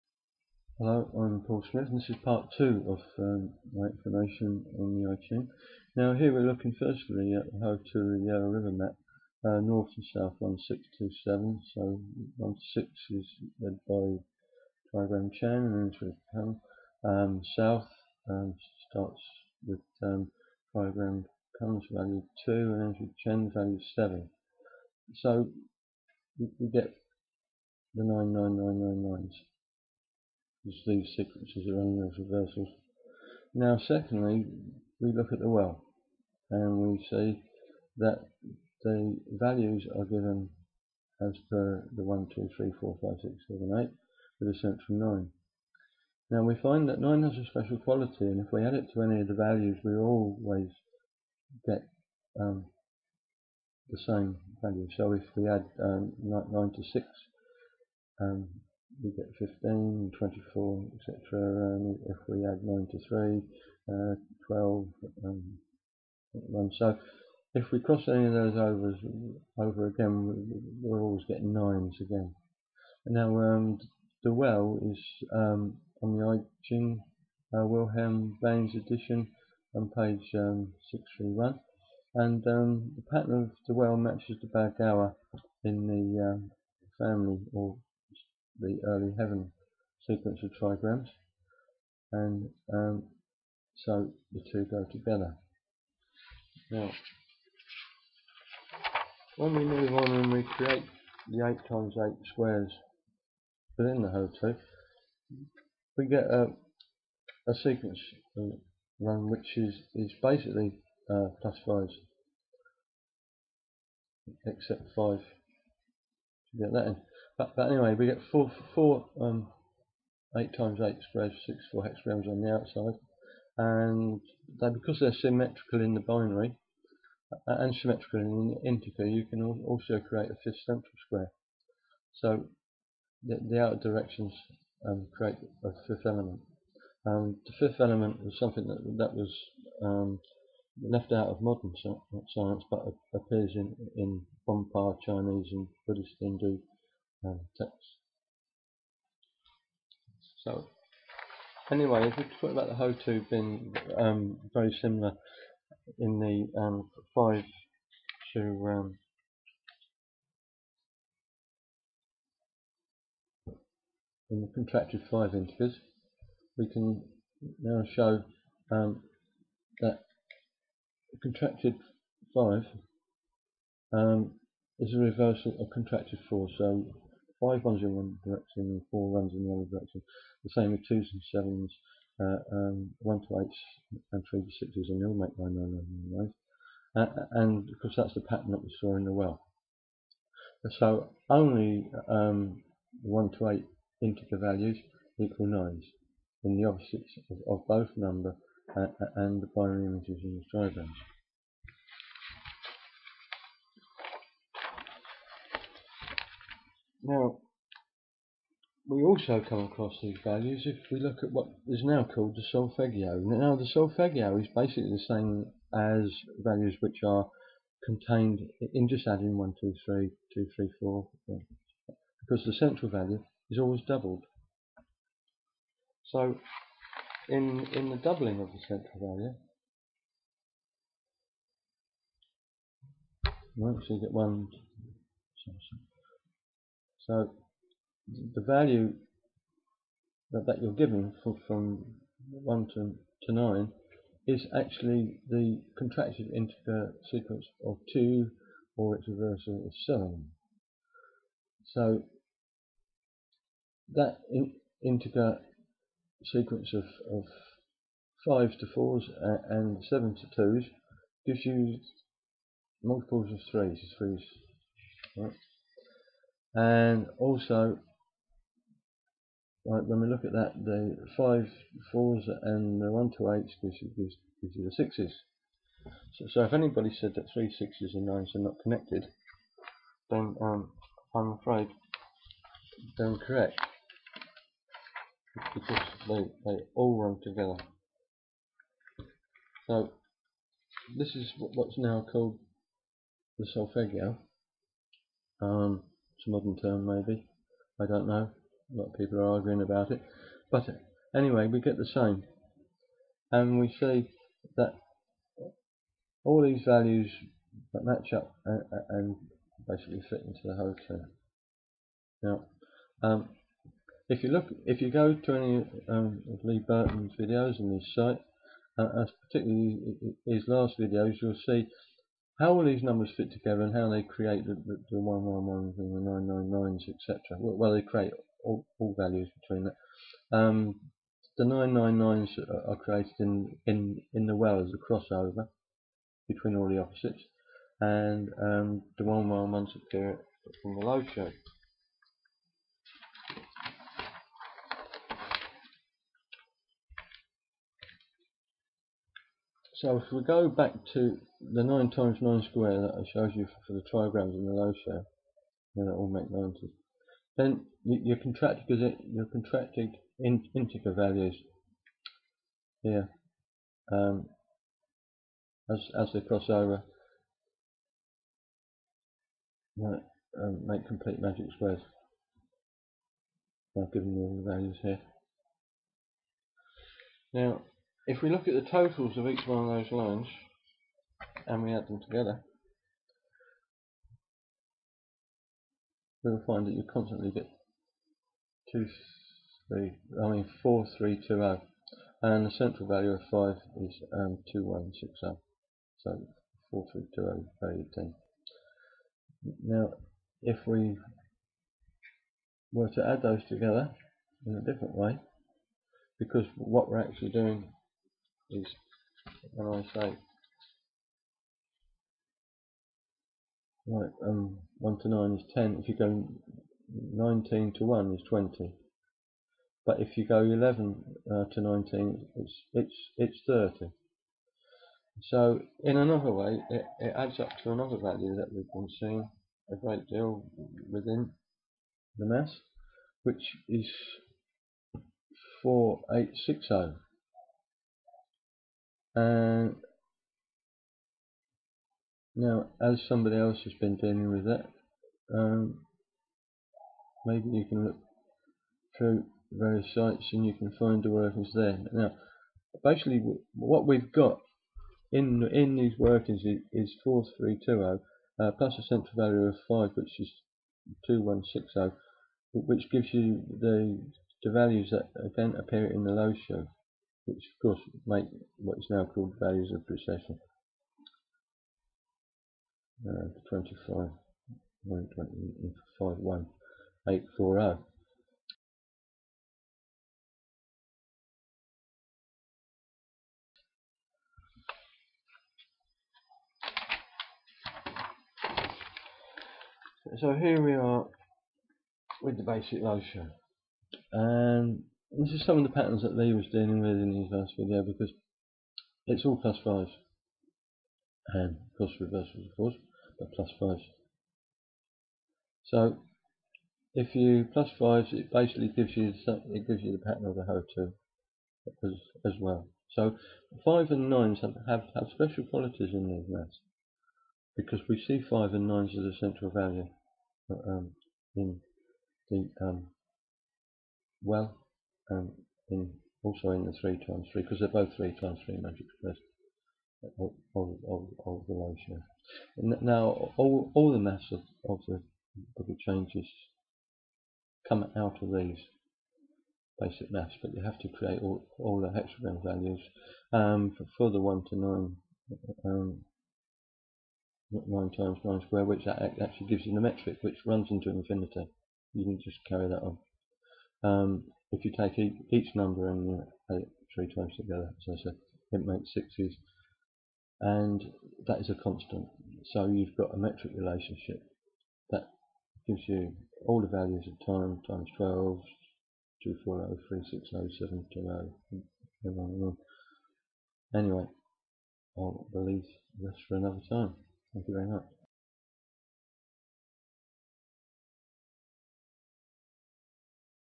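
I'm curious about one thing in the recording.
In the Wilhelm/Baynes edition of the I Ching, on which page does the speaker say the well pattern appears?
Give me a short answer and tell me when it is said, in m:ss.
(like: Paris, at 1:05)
631, at 1:20.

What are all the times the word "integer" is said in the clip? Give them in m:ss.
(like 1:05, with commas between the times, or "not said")
2:08, 2:45, 3:14, 4:06, 4:14, 6:00.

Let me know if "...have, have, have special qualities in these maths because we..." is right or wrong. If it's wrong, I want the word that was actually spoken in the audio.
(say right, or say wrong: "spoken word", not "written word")
right.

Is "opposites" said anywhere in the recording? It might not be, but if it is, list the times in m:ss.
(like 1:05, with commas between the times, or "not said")
3:16, 5:36.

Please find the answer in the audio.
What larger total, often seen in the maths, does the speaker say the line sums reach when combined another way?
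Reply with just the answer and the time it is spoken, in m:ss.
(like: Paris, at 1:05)
4860, at 7:15.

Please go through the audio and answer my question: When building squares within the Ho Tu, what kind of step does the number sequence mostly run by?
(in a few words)
Plus 5s.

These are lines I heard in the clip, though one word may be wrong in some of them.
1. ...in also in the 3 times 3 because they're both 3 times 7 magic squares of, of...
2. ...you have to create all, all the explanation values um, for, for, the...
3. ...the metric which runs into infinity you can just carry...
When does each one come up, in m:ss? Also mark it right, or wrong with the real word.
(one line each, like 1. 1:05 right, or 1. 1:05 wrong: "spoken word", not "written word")
1. 8:45 wrong: "3", not "7"
2. 9:00 wrong: "hexagon", not "explanation"
3. 9:09 right.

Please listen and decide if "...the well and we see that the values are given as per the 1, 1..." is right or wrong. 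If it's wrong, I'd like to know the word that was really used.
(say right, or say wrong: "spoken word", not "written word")
wrong: "2", not "1".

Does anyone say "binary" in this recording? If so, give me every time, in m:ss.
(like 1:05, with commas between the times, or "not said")
2:06, 3:19.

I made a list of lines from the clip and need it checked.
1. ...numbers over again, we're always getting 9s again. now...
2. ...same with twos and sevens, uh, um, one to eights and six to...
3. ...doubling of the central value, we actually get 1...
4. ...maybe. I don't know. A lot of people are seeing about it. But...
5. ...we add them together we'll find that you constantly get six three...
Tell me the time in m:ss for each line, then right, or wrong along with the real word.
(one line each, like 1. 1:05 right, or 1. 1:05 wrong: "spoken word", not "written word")
1. 1:08 wrong: "overs", not "numbers"
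2. 3:00 wrong: "three", not "six"
3. 3:47 right
4. 4:56 wrong: "arguing", not "seeing"
5. 6:21 wrong: "two", not "six".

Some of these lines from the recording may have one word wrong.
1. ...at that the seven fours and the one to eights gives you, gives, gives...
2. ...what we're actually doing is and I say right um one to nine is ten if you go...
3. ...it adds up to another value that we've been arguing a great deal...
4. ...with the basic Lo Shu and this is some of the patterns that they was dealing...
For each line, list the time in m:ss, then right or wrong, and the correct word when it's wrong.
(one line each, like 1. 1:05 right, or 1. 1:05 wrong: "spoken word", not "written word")
1. 4:30 wrong: "five", not "seven"
2. 6:46 right
3. 7:06 wrong: "seeing", not "arguing"
4. 8:12 right.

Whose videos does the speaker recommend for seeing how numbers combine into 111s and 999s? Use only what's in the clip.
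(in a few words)
Lee Burton.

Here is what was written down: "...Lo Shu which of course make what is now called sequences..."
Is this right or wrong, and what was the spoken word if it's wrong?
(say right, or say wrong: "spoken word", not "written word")
wrong: "values", not "sequences".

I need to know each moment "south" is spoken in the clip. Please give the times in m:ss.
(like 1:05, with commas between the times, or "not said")
0:10, 0:17.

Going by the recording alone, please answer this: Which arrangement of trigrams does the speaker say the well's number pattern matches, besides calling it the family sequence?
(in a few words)
Early heaven sequence.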